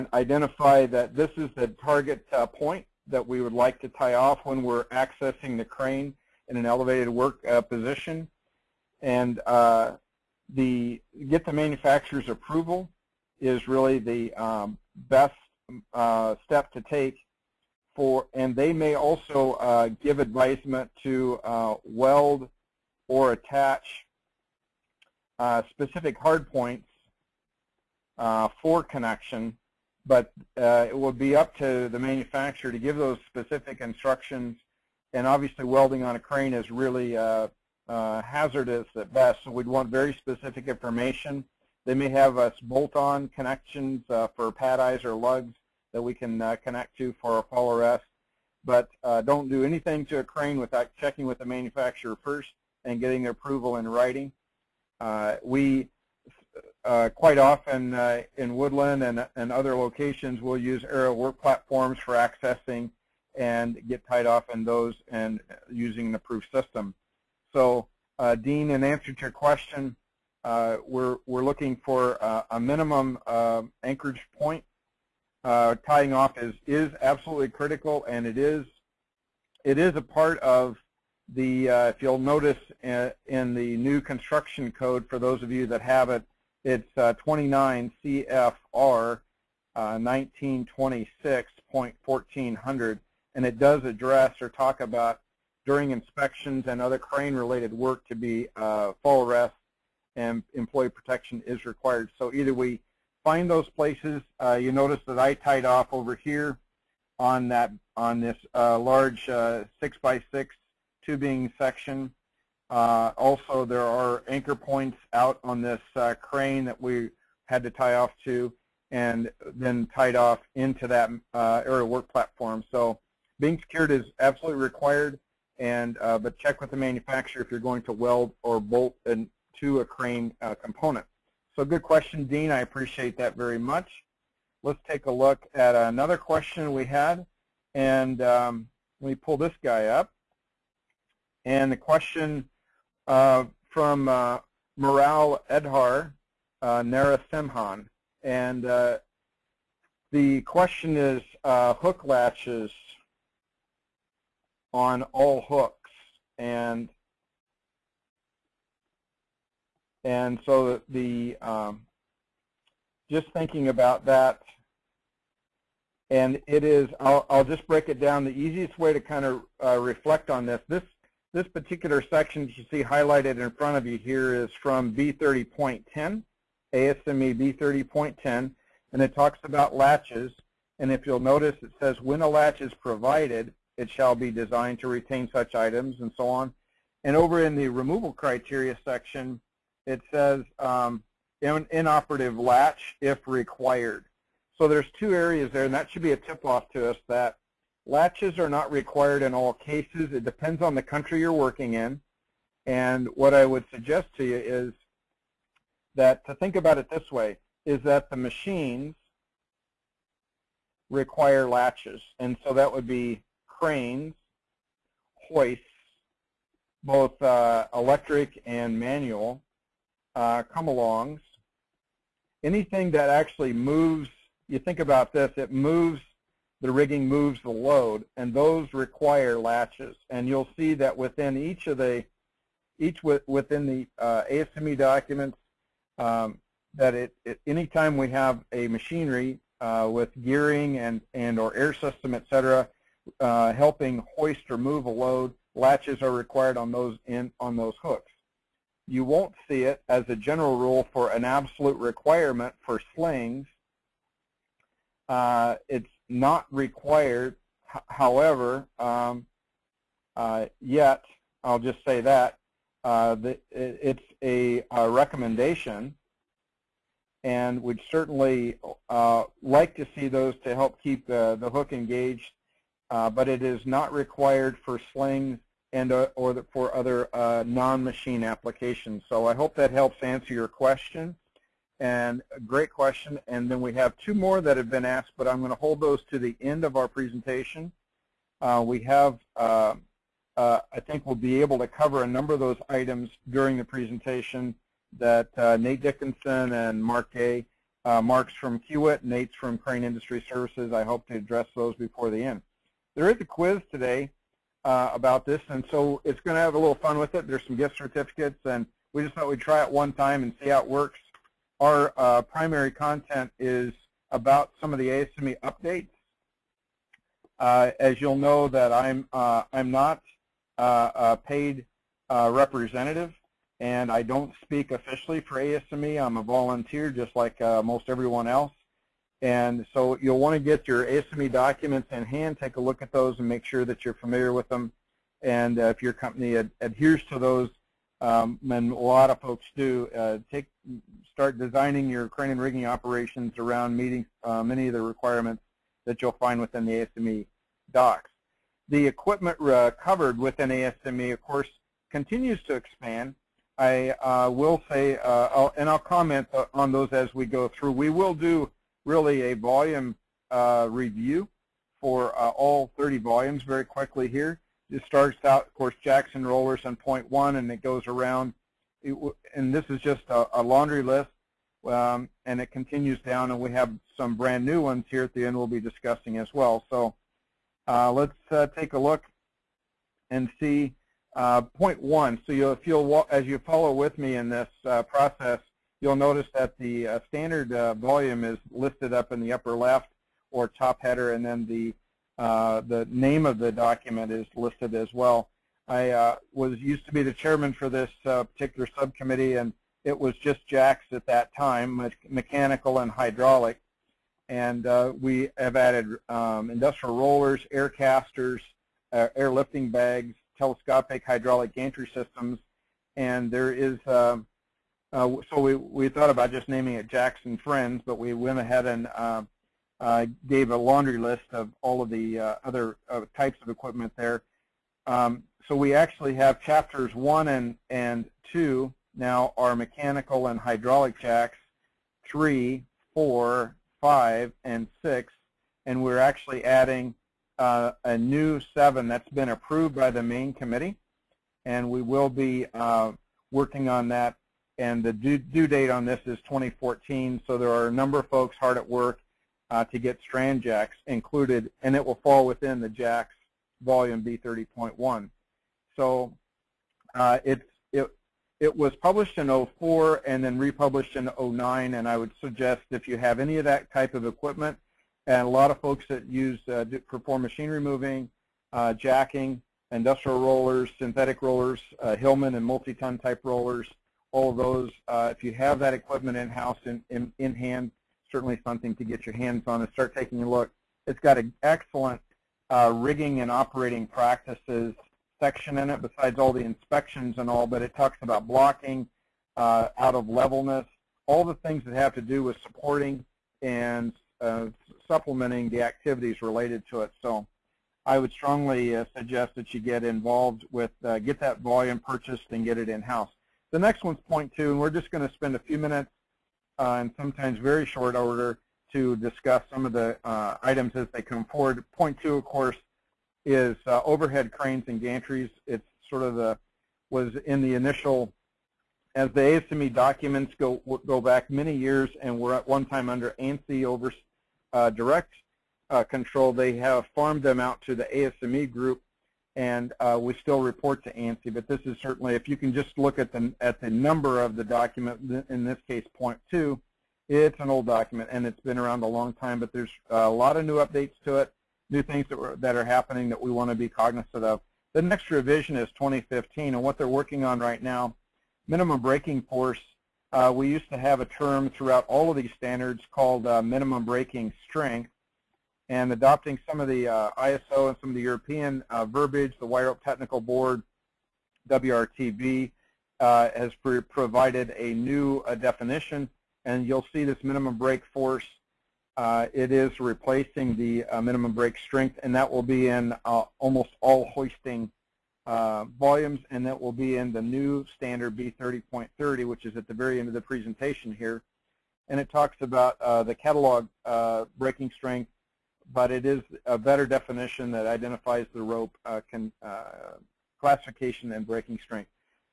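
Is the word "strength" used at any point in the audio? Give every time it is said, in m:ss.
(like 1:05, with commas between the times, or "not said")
9:14, 9:31, 9:44, 9:51.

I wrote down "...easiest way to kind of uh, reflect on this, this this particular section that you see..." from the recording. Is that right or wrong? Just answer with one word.
right.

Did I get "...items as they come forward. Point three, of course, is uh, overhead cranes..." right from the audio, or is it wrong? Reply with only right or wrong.
wrong.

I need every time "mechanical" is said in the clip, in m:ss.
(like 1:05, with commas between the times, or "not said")
6:42, 7:09.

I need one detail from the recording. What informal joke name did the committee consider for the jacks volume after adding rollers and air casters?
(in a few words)
Jacks and Friends.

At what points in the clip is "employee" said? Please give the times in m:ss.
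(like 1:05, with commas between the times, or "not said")
1:40.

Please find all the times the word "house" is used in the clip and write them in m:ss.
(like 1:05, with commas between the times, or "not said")
7:56, 8:22.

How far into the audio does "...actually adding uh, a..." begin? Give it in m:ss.
7:15.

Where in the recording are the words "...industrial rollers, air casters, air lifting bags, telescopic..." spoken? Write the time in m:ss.
6:46.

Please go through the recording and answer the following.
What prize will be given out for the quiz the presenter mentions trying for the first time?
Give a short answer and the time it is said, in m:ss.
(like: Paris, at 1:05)
gift certificates, at 5:07.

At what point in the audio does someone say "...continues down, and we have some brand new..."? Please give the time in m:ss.
6:12.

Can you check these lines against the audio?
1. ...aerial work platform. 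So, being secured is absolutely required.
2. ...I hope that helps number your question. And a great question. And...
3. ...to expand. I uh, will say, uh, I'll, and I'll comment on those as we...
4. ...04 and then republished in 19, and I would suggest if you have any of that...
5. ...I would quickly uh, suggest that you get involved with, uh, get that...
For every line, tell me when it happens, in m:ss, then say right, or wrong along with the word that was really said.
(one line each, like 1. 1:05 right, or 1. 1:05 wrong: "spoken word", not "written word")
1. 2:01 right
2. 4:39 wrong: "answer", not "number"
3. 5:52 right
4. 7:39 wrong: "09", not "19"
5. 8:17 wrong: "strongly", not "quickly".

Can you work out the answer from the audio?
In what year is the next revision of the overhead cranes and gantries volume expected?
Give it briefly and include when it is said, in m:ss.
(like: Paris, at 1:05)
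2015, at 9:05.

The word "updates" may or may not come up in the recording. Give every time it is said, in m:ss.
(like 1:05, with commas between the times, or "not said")
5:15, 9:00.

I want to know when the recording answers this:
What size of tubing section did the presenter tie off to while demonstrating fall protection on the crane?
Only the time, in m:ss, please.
1:49.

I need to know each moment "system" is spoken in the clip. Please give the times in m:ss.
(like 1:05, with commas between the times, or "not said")
1:06, 4:01, 6:51.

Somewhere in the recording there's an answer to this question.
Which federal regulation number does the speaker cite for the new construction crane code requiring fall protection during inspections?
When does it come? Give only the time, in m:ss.
1:27.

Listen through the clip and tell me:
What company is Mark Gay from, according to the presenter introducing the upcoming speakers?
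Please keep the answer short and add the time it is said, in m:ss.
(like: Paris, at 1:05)
Kiewit, at 4:58.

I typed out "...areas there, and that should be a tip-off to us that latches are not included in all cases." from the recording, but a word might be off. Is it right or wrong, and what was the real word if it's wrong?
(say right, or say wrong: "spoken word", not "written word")
wrong: "required", not "included".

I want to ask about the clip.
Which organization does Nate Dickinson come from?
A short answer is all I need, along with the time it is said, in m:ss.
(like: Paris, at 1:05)
Crane Industry Services, at 4:59.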